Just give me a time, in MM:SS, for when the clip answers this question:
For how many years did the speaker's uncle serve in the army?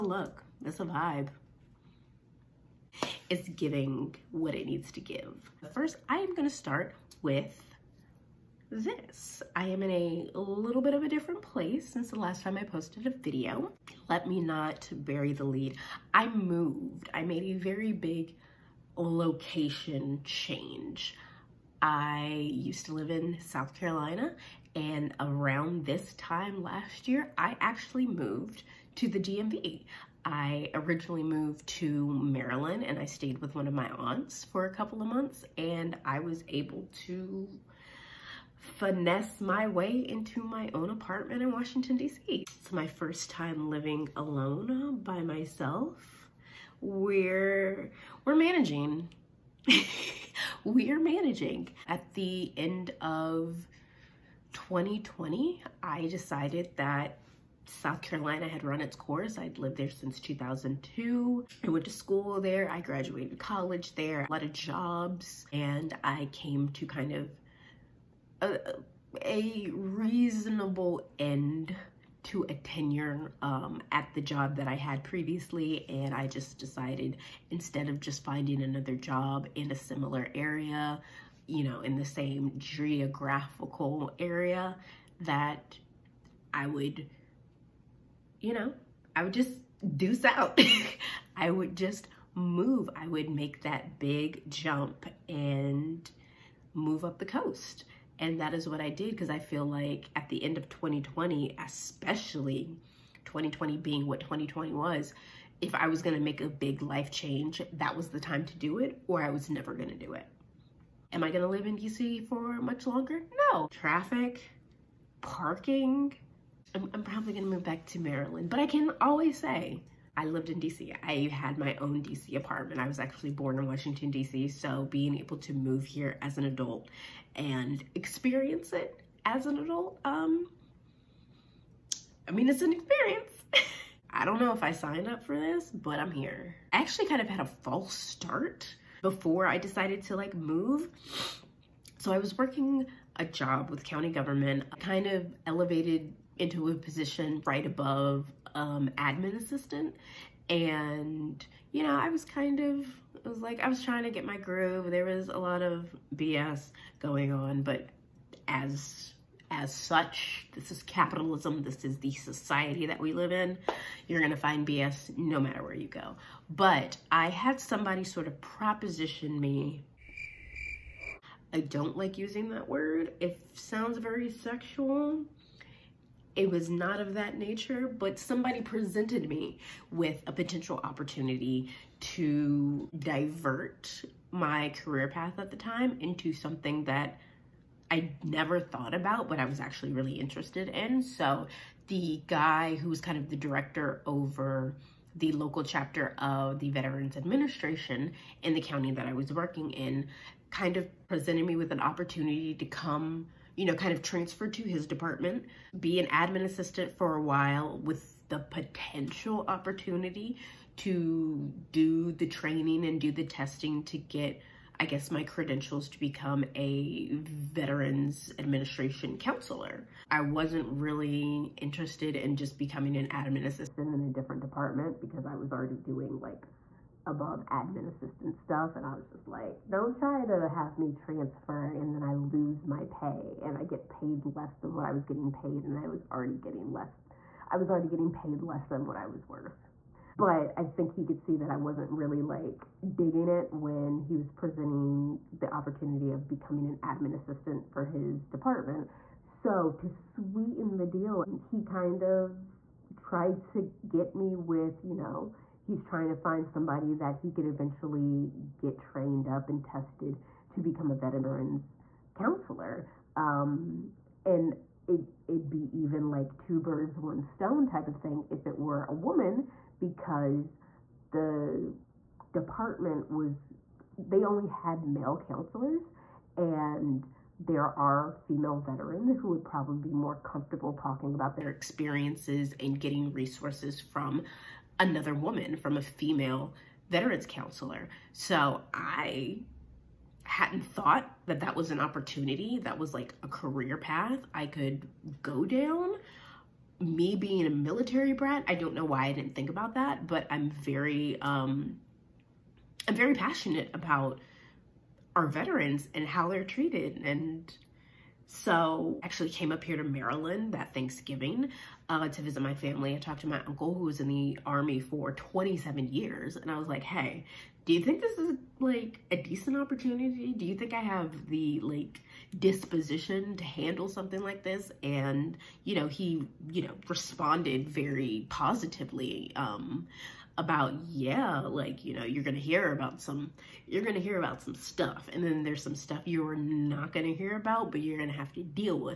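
05:15.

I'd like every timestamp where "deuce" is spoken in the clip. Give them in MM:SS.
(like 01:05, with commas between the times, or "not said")
01:29.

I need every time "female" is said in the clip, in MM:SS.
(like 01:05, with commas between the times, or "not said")
04:38, 04:45.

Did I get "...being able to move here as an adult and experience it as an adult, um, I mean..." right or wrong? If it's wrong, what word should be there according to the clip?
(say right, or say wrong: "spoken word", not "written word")
right.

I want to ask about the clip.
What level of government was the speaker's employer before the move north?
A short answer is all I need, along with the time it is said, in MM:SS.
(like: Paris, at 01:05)
County government, at 02:23.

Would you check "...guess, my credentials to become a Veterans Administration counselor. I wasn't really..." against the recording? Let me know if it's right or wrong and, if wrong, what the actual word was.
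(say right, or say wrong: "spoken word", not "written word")
right.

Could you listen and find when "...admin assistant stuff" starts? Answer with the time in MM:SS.
03:47.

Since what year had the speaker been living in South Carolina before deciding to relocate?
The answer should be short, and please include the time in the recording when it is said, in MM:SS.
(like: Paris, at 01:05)
2002, at 01:00.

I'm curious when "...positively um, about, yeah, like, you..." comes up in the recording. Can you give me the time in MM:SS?
05:28.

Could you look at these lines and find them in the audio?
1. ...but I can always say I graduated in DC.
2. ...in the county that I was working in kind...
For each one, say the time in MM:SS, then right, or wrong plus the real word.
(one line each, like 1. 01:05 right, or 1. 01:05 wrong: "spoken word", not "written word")
1. 01:58 wrong: "lived", not "graduated"
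2. 03:18 right.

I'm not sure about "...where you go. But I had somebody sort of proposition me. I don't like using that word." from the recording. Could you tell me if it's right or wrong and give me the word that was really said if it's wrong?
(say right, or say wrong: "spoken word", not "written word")
right.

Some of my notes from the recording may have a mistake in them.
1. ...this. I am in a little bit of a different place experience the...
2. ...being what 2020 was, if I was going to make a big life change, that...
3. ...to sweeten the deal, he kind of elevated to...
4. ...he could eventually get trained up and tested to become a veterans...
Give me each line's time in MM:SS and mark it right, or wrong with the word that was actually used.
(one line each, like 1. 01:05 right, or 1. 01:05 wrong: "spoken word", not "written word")
1. 00:08 wrong: "since", not "experience"
2. 01:43 right
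3. 04:09 wrong: "tried", not "elevated"
4. 04:17 right.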